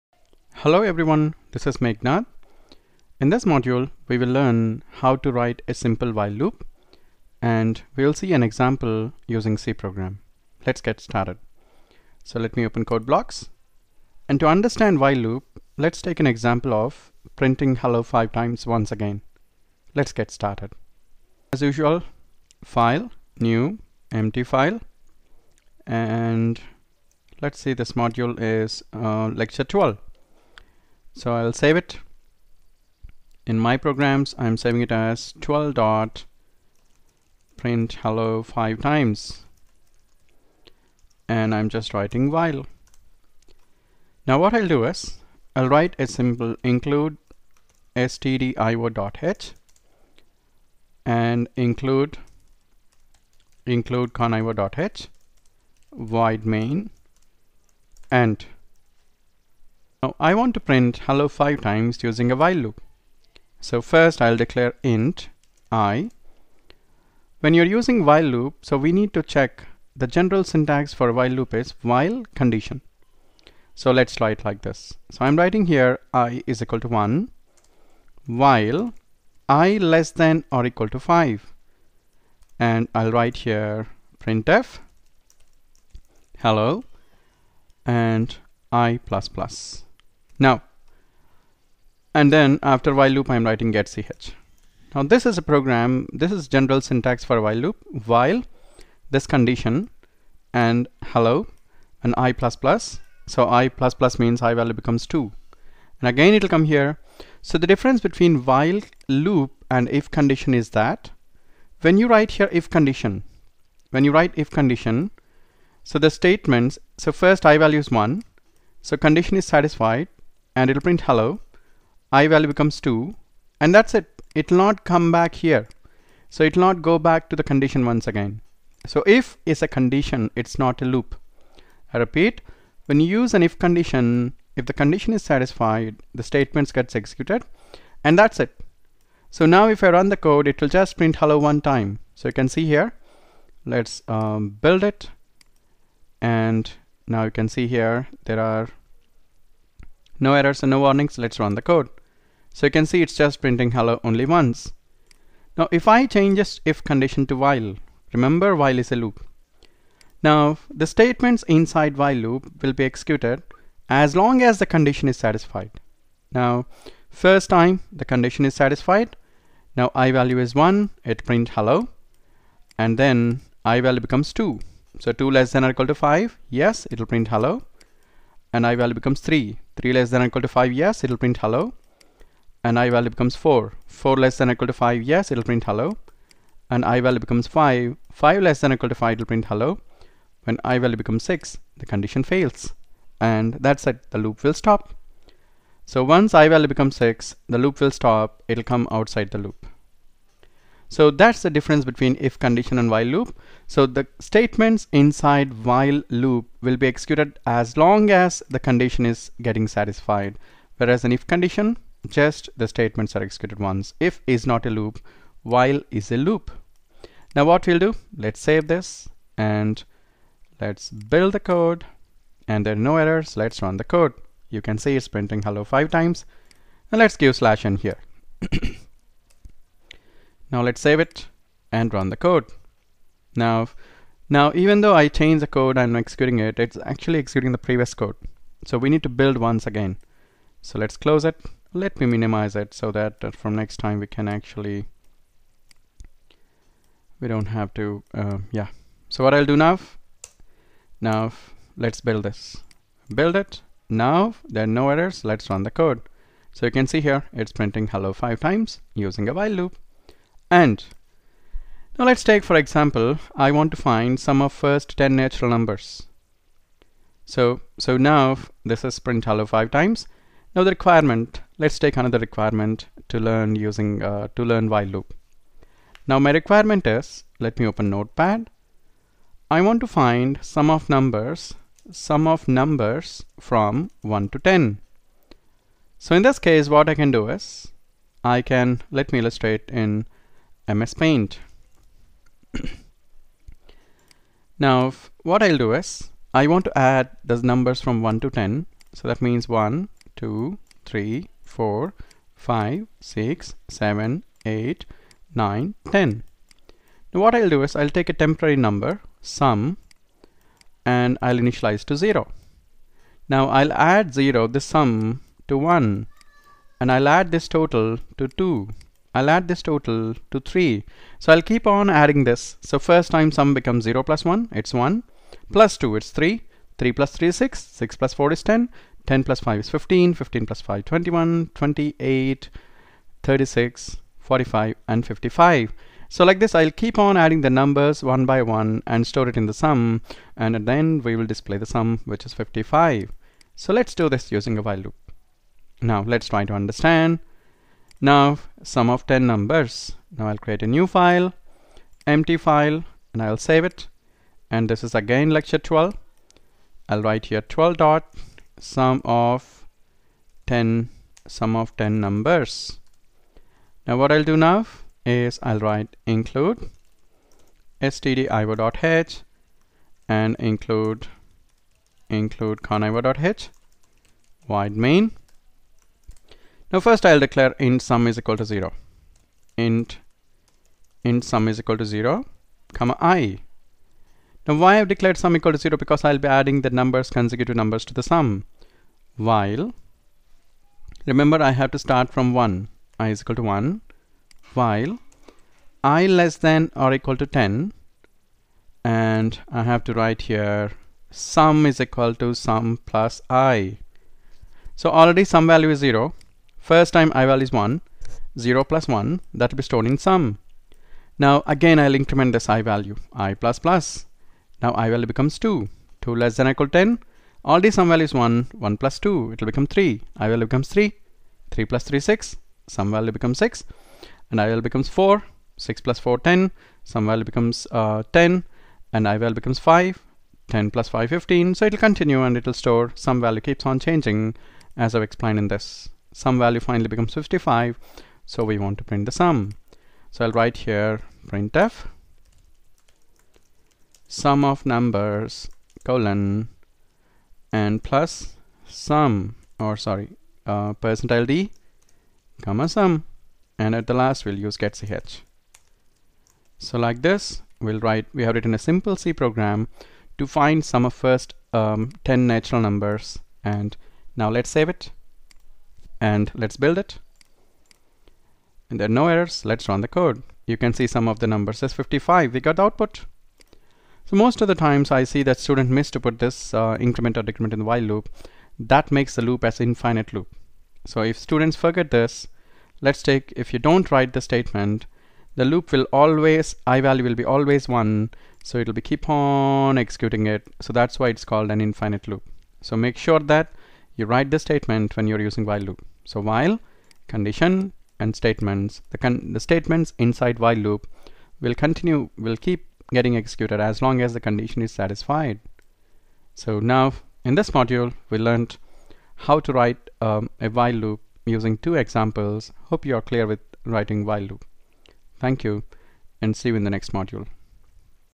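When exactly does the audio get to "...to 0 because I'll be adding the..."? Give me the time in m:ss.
6:25.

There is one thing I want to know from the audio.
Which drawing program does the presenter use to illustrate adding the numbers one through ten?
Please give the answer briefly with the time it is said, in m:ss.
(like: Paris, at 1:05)
MS Paint, at 4:50.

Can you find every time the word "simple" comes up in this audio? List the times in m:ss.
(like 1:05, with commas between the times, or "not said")
0:05, 0:46, 7:38.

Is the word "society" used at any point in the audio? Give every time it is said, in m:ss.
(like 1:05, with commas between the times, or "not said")
not said.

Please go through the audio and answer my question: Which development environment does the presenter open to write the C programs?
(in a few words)
Code::Blocks.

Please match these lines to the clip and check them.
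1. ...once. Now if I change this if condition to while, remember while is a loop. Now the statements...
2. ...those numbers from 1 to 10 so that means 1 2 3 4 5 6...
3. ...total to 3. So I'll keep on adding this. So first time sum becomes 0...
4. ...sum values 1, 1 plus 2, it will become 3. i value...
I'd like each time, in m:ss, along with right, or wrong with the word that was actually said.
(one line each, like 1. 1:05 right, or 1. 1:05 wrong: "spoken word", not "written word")
1. 2:34 right
2. 4:57 right
3. 5:19 right
4. 6:57 right.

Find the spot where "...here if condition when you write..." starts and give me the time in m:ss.
1:52.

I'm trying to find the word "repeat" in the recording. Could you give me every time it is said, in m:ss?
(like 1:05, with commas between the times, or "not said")
2:12.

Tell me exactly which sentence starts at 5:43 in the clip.
So let's do this using a while loop.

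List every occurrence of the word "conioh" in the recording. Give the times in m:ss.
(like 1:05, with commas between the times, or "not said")
0:54, 6:12.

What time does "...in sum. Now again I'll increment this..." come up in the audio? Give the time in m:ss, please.
6:49.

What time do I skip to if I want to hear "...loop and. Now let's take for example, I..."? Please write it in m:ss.
4:19.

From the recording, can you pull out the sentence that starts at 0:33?
In my programs, I'm saving it as 12 dot print hello five times.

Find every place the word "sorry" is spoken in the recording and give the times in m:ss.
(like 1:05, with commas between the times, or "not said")
7:29.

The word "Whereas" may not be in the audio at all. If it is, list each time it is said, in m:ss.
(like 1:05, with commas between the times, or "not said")
3:30.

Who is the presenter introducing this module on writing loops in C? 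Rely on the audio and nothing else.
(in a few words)
Meghnath.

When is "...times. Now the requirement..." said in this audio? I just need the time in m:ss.
4:29.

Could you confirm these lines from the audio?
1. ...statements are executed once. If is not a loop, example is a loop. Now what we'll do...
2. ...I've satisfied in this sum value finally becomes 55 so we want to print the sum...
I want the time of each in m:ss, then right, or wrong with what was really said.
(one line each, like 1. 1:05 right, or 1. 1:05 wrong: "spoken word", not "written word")
1. 3:32 wrong: "while", not "example"
2. 7:14 wrong: "explained", not "satisfied".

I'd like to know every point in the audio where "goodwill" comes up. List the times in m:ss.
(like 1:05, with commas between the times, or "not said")
not said.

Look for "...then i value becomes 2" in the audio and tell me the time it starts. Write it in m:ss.
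2:52.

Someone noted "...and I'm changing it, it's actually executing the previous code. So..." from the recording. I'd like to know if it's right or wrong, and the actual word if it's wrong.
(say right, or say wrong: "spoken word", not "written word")
wrong: "executing", not "changing".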